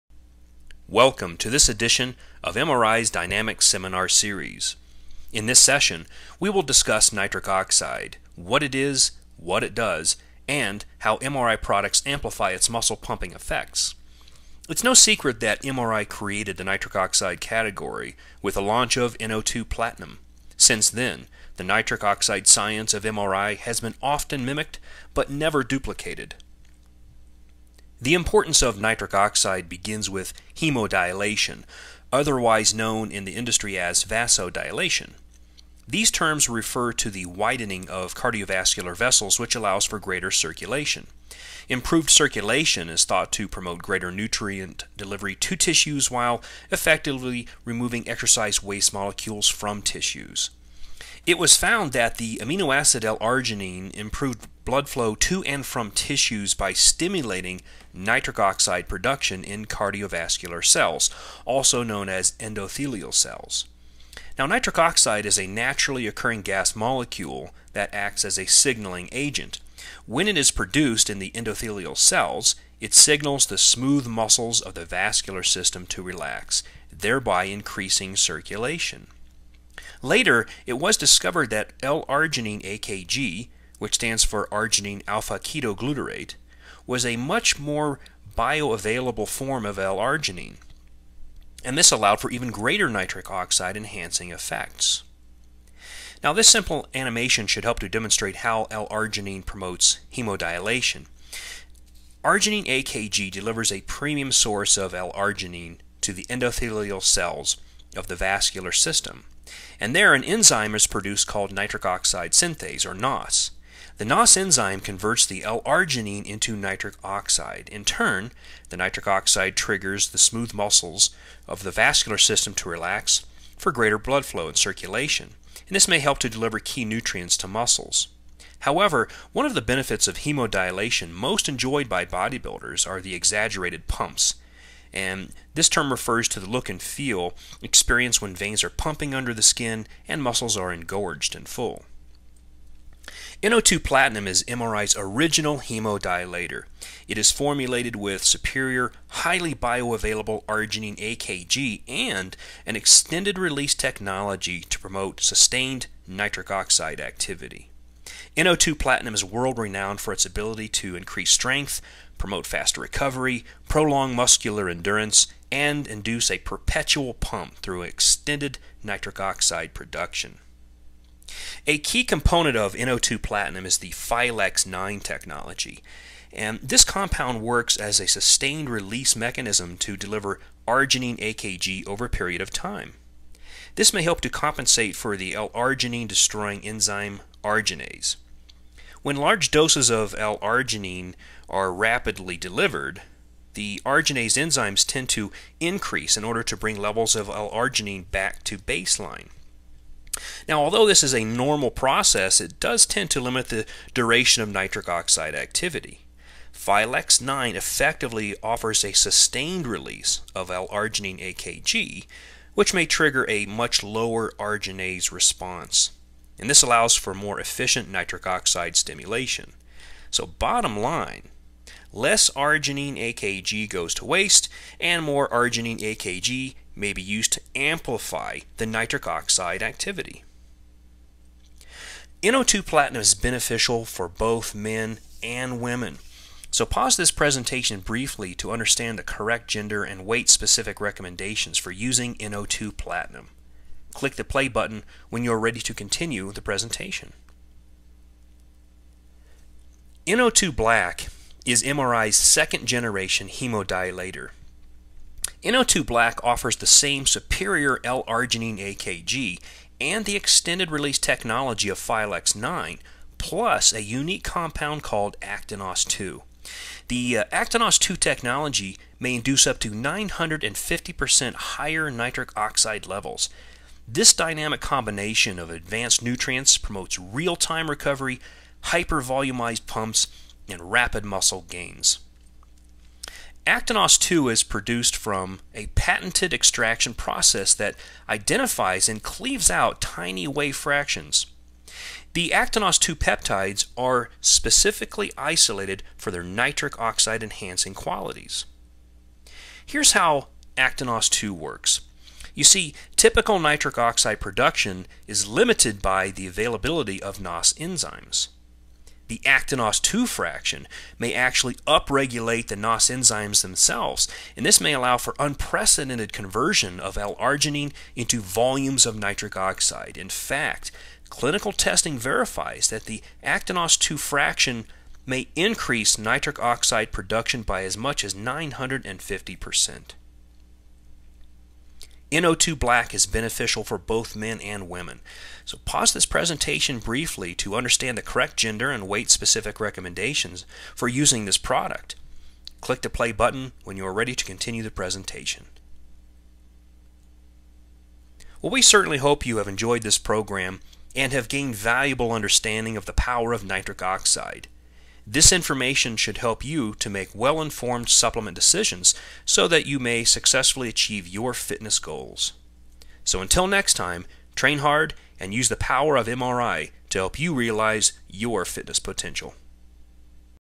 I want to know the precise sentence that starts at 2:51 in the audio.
A key component of NO2 platinum is the Phylex 9 technology.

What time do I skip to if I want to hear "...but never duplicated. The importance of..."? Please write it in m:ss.
0:25.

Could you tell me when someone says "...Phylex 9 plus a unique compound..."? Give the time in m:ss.
4:21.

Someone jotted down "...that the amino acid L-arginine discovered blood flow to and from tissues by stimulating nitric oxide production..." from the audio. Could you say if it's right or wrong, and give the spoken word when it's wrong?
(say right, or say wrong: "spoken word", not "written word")
wrong: "improved", not "discovered".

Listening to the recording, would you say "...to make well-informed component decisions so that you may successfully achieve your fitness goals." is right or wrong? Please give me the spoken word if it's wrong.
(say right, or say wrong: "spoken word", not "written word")
wrong: "supplement", not "component".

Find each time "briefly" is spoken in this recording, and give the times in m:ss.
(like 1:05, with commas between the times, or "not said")
3:57, 5:36.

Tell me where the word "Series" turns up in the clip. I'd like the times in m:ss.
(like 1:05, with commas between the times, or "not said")
0:04.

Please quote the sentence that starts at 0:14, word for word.
It's no secret that MRI created the nitric oxide category with the launch of NO2 Platinum.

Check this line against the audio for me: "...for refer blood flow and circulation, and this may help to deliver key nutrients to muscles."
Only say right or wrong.
wrong.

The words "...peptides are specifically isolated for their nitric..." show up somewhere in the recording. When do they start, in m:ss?
4:52.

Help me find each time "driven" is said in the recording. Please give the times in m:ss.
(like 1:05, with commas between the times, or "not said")
not said.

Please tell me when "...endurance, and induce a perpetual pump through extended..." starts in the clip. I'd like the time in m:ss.
2:44.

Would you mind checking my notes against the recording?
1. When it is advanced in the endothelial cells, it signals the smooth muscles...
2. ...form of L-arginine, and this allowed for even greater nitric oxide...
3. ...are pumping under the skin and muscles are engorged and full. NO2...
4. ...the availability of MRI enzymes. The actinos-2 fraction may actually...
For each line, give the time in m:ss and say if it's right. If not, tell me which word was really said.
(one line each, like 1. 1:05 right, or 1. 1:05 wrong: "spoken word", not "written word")
1. 1:10 wrong: "produced", not "advanced"
2. 1:29 right
3. 2:18 right
4. 5:06 wrong: "NOS", not "MRI".